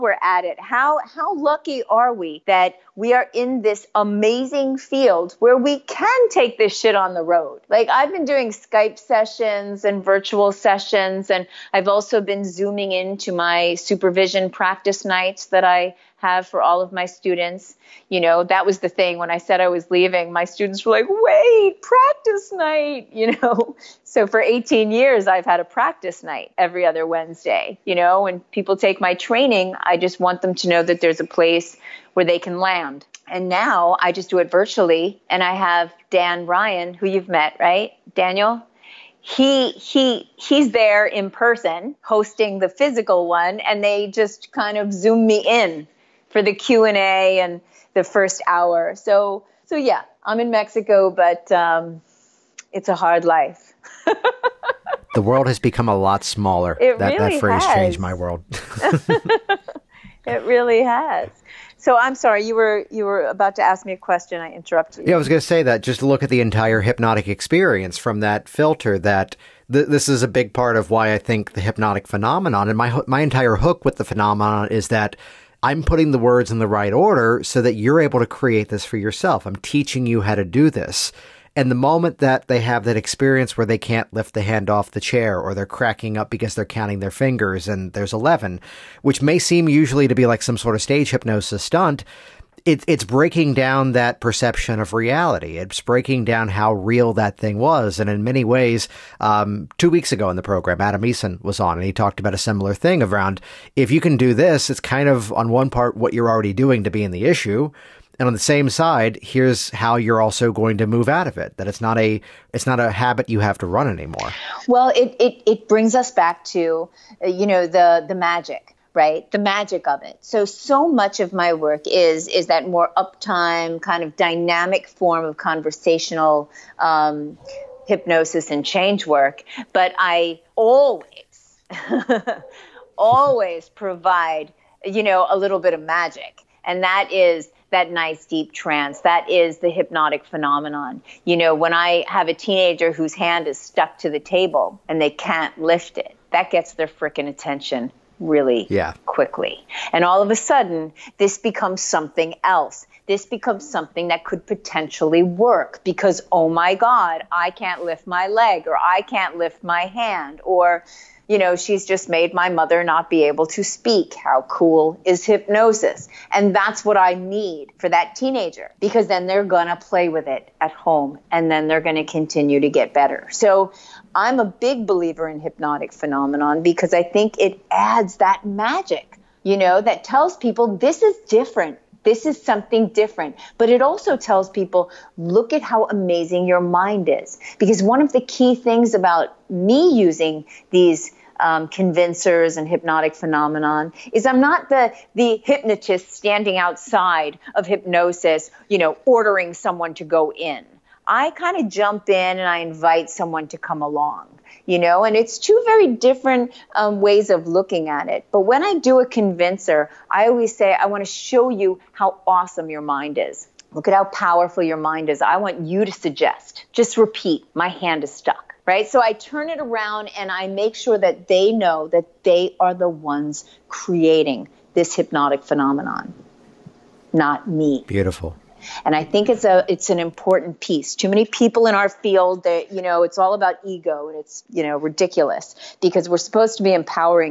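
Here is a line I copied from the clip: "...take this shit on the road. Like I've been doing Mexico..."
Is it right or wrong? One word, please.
wrong.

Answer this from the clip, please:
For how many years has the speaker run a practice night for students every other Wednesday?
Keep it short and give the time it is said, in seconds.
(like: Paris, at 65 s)
18, at 24 s.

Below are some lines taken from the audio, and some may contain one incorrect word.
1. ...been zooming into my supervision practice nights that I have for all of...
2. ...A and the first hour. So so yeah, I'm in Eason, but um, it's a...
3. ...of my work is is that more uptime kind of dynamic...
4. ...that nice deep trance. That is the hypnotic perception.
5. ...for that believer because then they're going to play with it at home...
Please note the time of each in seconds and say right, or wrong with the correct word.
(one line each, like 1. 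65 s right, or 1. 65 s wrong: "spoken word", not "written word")
1. 12 s right
2. 46 s wrong: "Mexico", not "Eason"
3. 121 s right
4. 137 s wrong: "phenomenon", not "perception"
5. 167 s wrong: "teenager", not "believer".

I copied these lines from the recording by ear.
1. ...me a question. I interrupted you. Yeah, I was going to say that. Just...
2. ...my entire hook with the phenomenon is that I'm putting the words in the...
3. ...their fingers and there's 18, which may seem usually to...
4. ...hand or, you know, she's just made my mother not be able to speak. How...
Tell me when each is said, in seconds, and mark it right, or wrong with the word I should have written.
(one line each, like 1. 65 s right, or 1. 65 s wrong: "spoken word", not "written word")
1. 63 s right
2. 73 s right
3. 87 s wrong: "11", not "18"
4. 159 s right.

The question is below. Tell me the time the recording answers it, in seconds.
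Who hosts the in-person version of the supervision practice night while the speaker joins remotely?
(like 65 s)
36 s.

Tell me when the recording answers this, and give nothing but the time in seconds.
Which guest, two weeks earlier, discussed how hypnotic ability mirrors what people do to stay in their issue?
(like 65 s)
100 s.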